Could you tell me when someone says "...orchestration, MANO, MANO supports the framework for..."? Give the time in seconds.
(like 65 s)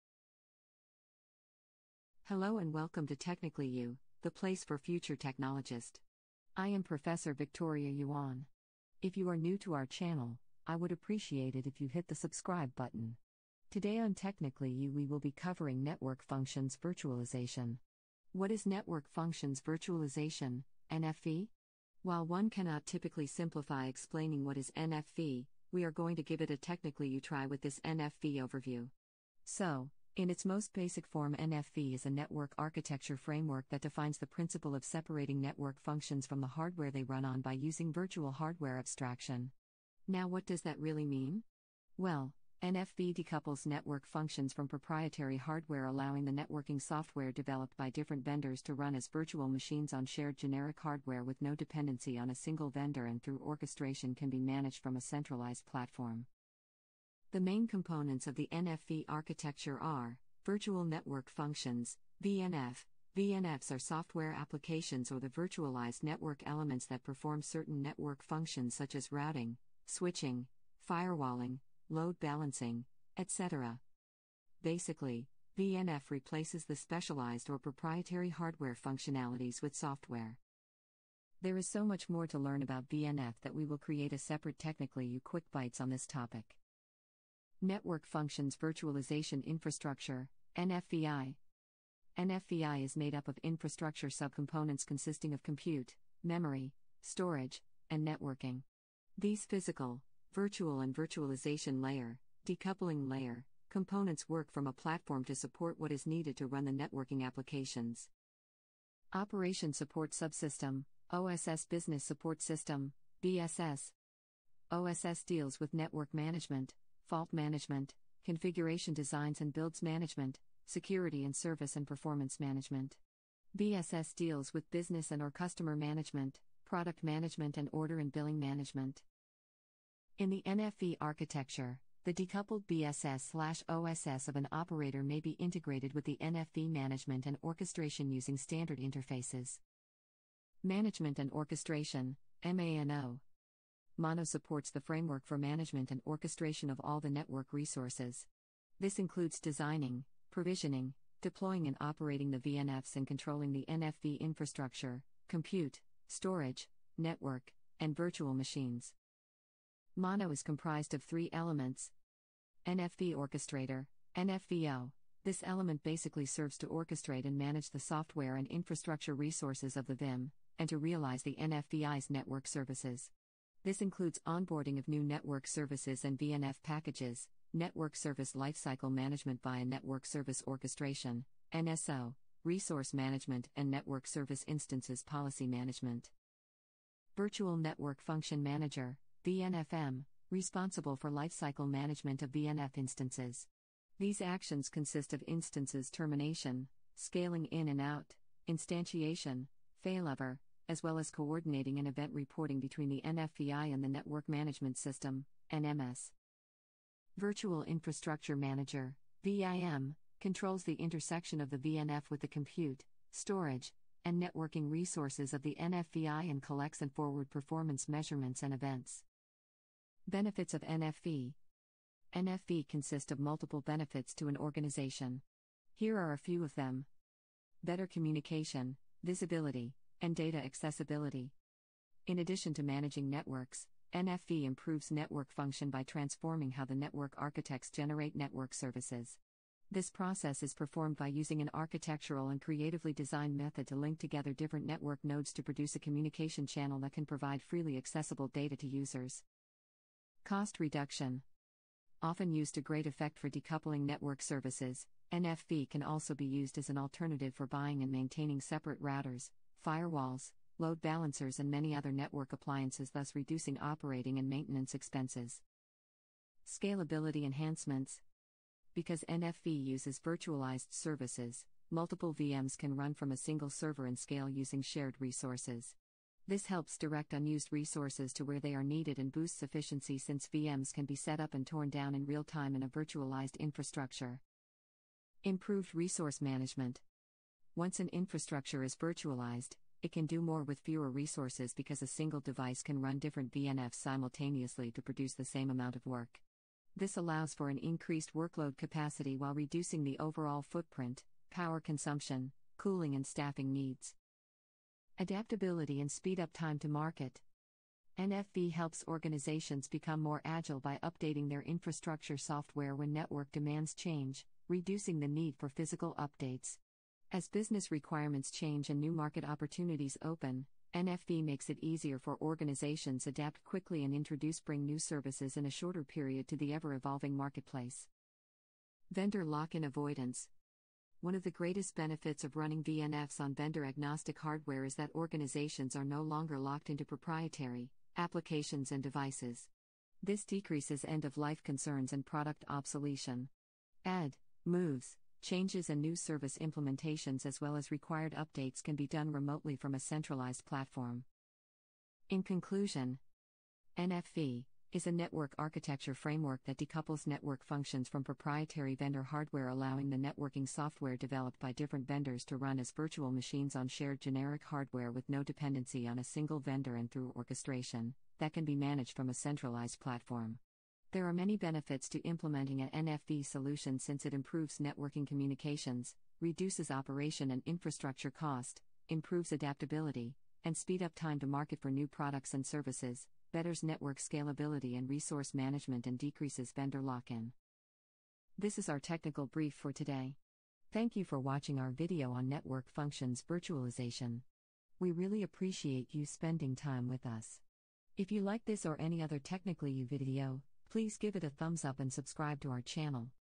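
141 s.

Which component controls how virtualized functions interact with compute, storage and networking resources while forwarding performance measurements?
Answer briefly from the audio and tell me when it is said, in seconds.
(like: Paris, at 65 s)
Virtual Infrastructure Manager, at 207 s.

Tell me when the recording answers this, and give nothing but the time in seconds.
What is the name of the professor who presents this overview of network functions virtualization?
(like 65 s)
7 s.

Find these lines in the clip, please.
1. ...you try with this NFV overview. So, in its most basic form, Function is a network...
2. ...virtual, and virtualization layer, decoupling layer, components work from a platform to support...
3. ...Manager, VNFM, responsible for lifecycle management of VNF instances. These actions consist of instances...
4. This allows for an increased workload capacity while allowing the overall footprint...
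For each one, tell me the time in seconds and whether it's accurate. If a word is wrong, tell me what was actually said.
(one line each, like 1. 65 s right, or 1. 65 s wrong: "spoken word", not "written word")
1. 27 s wrong: "NFV", not "Function"
2. 100 s right
3. 188 s right
4. 296 s wrong: "reducing", not "allowing".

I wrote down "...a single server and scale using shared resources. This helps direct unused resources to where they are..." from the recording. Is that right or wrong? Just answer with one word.
right.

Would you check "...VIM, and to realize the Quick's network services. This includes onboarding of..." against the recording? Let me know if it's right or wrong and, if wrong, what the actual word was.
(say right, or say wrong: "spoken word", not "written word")
wrong: "NFVI", not "Quick".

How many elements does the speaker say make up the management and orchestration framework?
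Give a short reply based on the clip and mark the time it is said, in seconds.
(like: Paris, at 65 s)
3, at 161 s.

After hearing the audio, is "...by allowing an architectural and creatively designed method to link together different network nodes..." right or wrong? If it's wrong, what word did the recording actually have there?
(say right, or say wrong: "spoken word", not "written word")
wrong: "using", not "allowing".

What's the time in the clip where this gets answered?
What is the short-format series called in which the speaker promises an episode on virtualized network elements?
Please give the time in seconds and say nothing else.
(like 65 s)
85 s.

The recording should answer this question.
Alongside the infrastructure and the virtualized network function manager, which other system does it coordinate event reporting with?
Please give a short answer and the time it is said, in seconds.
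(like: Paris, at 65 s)
Network Management System, at 203 s.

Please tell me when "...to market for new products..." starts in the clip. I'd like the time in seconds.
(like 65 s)
381 s.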